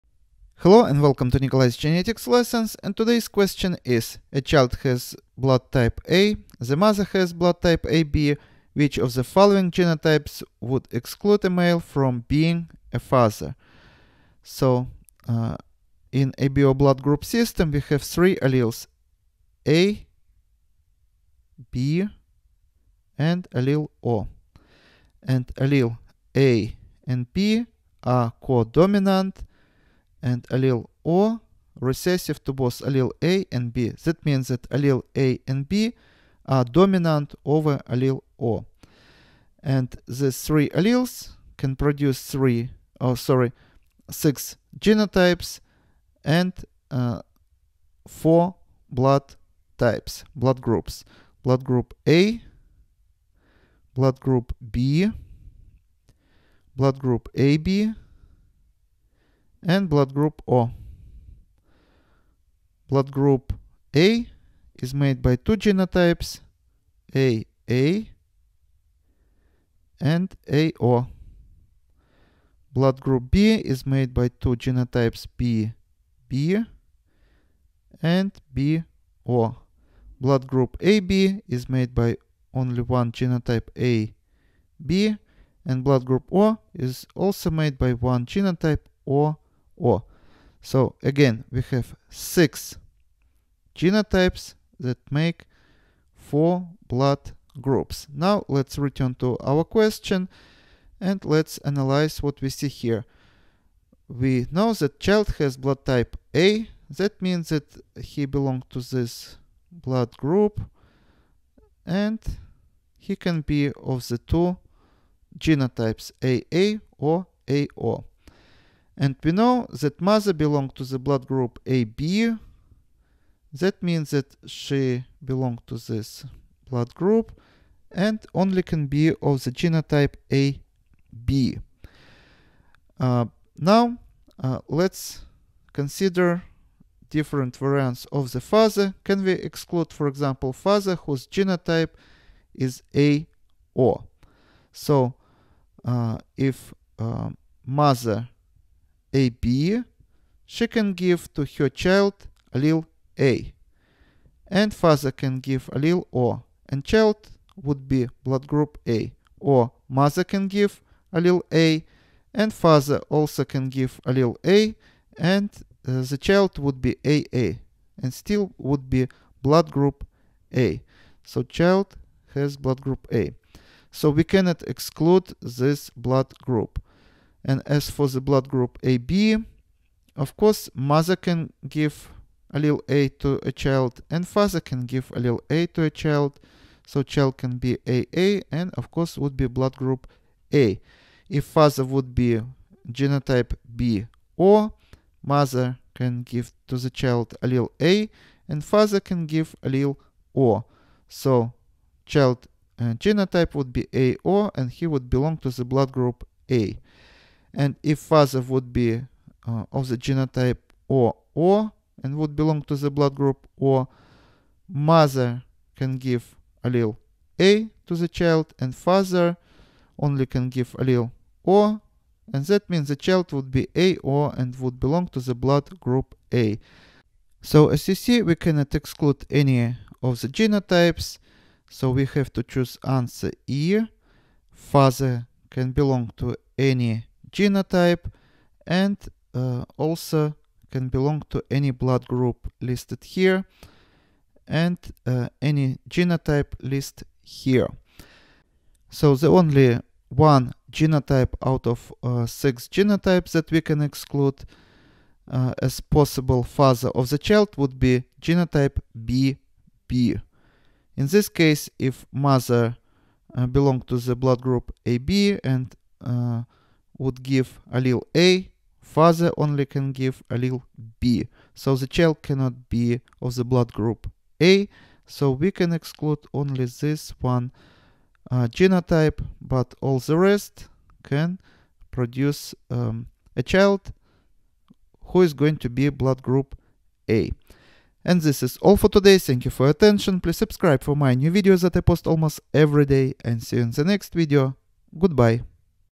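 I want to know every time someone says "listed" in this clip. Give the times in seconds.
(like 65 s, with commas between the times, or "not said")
242 s, 246 s.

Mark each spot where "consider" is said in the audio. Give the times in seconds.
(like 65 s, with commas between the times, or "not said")
135 s.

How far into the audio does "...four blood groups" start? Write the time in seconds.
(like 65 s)
96 s.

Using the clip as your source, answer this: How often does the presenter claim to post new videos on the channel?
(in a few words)
Almost every day.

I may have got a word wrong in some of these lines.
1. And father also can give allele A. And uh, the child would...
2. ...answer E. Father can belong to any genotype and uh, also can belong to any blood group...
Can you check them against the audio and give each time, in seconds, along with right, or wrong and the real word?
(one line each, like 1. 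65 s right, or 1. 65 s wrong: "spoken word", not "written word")
1. 162 s right
2. 232 s right.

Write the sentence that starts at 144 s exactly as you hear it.
So, uh, if uh, mother AB, she can give to her child allele A.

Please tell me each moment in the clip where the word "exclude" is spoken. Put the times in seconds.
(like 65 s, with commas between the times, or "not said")
10 s, 139 s, 174 s, 228 s, 253 s, 275 s.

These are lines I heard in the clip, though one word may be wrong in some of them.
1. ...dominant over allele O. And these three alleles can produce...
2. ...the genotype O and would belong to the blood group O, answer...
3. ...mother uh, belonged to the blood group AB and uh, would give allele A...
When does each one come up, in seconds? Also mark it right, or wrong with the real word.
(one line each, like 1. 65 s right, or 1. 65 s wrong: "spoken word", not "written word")
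1. 36 s right
2. 209 s wrong: "mother", not "answer"
3. 262 s right.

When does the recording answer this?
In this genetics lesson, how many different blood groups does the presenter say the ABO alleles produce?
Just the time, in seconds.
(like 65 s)
48 s.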